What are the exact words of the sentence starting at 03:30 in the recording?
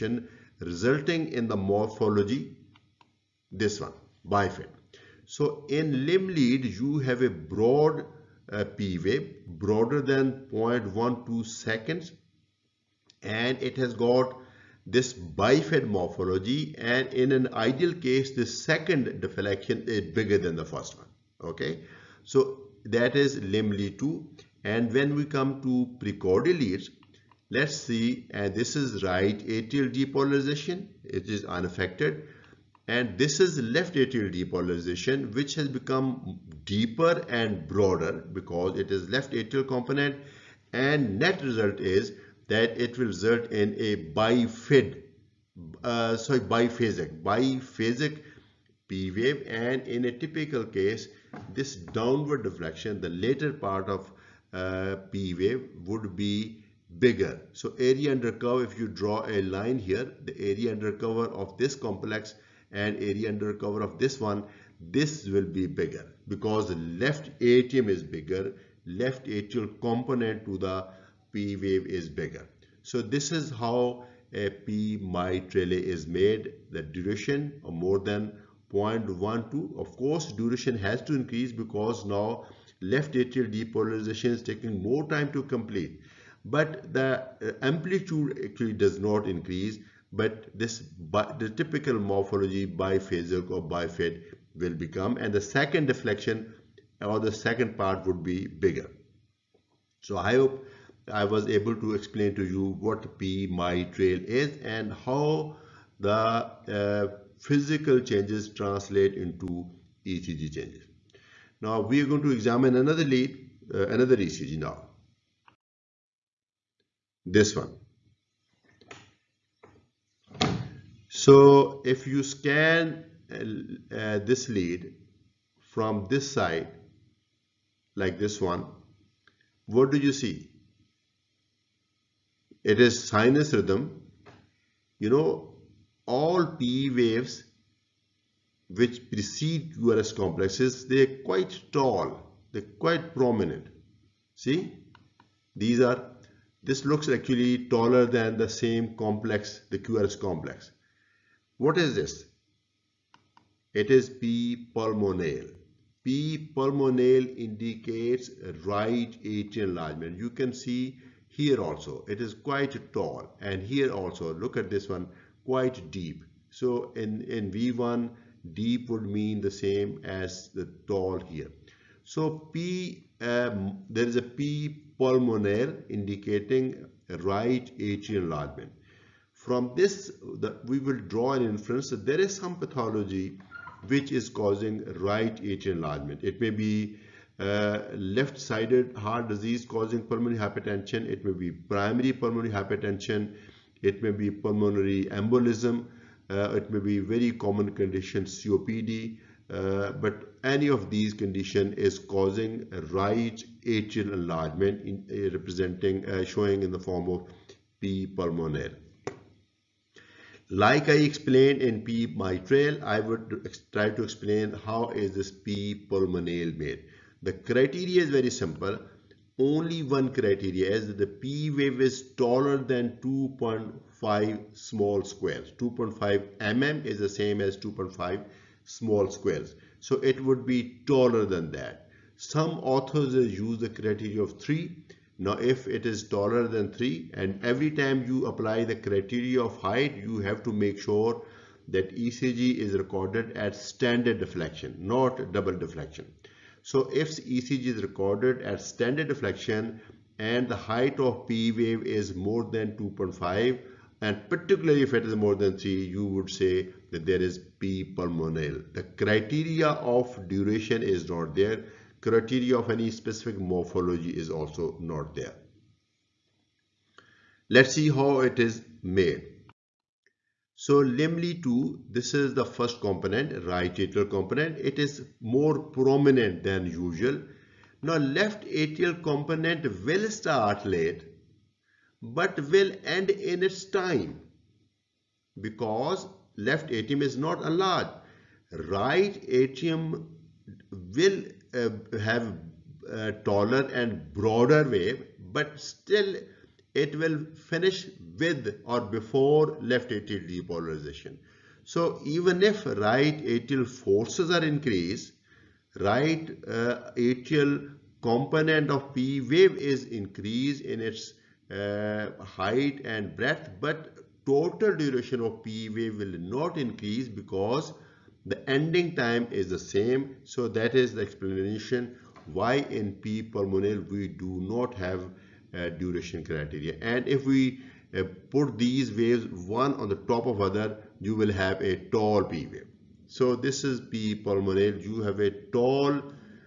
Like I explained in P mitral, I would try to explain how is this P pulmonale made.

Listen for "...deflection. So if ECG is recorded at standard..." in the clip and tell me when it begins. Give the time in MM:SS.
04:05.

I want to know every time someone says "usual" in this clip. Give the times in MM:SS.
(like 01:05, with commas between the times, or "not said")
04:36.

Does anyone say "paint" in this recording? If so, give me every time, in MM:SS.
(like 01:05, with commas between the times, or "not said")
not said.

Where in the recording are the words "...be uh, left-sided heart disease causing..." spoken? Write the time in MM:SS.
03:06.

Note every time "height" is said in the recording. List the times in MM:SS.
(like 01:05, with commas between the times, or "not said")
03:59, 04:10, 05:12.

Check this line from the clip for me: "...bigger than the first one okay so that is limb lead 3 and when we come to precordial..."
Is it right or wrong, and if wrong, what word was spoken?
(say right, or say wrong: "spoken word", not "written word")
wrong: "2", not "3".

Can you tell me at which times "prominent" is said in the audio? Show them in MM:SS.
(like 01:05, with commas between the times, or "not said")
02:23, 04:35.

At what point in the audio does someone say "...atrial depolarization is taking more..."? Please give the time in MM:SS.
01:23.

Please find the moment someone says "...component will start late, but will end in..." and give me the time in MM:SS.
04:39.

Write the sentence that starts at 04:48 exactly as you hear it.
Right atrium will uh, have a uh, taller and broader wave, but still it will finish with or before left atrial depolarization.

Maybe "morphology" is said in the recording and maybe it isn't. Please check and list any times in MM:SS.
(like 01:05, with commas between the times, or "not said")
00:01, 00:15, 01:31, 04:23.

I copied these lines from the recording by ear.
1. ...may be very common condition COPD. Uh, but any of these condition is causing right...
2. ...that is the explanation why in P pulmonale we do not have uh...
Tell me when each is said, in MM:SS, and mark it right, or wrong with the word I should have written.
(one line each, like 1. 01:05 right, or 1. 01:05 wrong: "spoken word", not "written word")
1. 03:16 right
2. 05:20 right.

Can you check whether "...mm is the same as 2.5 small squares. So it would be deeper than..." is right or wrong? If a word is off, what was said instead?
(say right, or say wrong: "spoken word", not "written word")
wrong: "taller", not "deeper".